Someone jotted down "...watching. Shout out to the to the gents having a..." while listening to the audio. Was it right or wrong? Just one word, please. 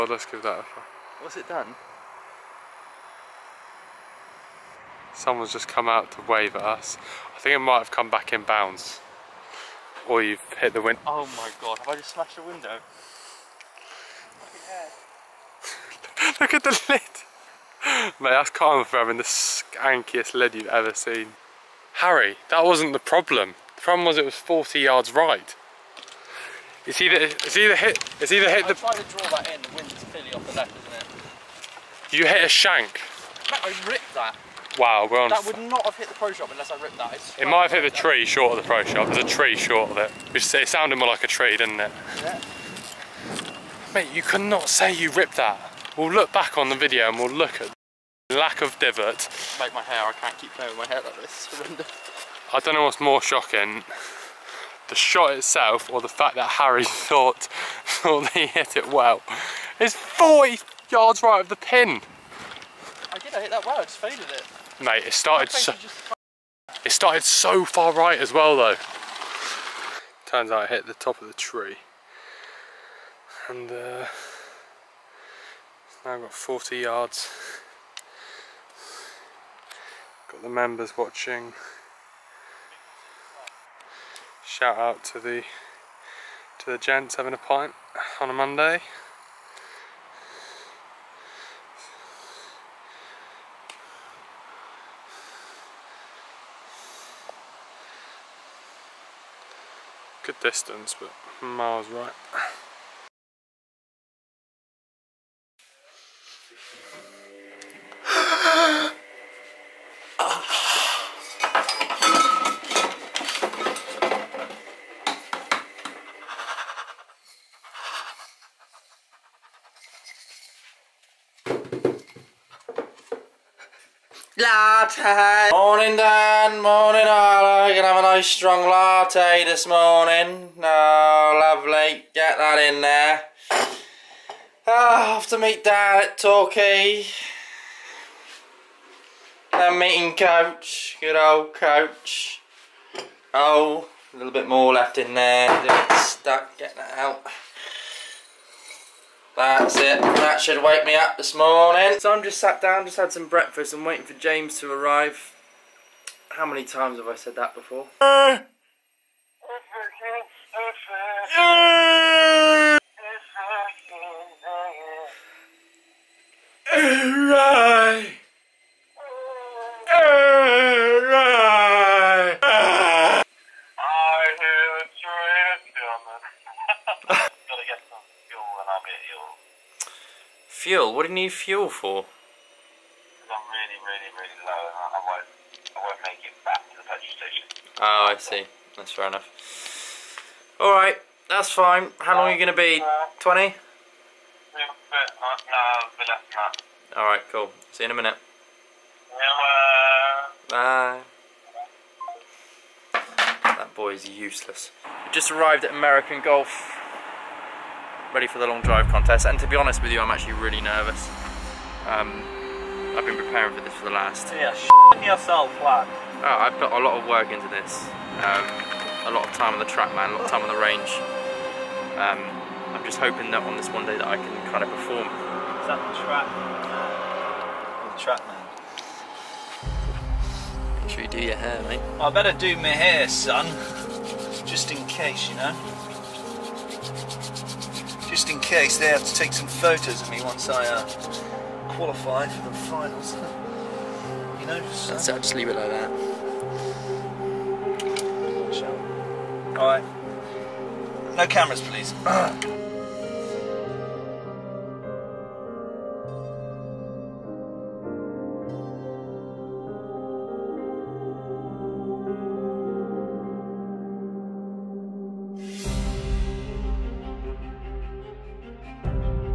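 right.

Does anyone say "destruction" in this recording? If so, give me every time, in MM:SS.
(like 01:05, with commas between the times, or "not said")
not said.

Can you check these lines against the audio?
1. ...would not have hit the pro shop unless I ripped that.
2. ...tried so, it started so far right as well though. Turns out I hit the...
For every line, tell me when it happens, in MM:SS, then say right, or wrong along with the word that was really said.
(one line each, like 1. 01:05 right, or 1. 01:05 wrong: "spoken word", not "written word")
1. 00:35 right
2. 01:05 wrong: "started", not "tried".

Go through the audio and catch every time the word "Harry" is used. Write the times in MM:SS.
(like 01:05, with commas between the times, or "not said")
00:21, 00:56.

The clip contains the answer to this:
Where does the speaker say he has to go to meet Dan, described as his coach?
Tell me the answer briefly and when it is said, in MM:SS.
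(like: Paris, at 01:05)
Torquay, at 02:16.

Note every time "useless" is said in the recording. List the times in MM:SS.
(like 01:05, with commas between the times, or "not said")
03:24.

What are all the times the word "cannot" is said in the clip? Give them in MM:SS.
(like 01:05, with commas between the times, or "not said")
00:44.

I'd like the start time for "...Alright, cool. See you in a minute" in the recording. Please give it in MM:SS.
03:17.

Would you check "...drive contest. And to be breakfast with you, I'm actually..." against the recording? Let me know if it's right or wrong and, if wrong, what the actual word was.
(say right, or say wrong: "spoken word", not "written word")
wrong: "honest", not "breakfast".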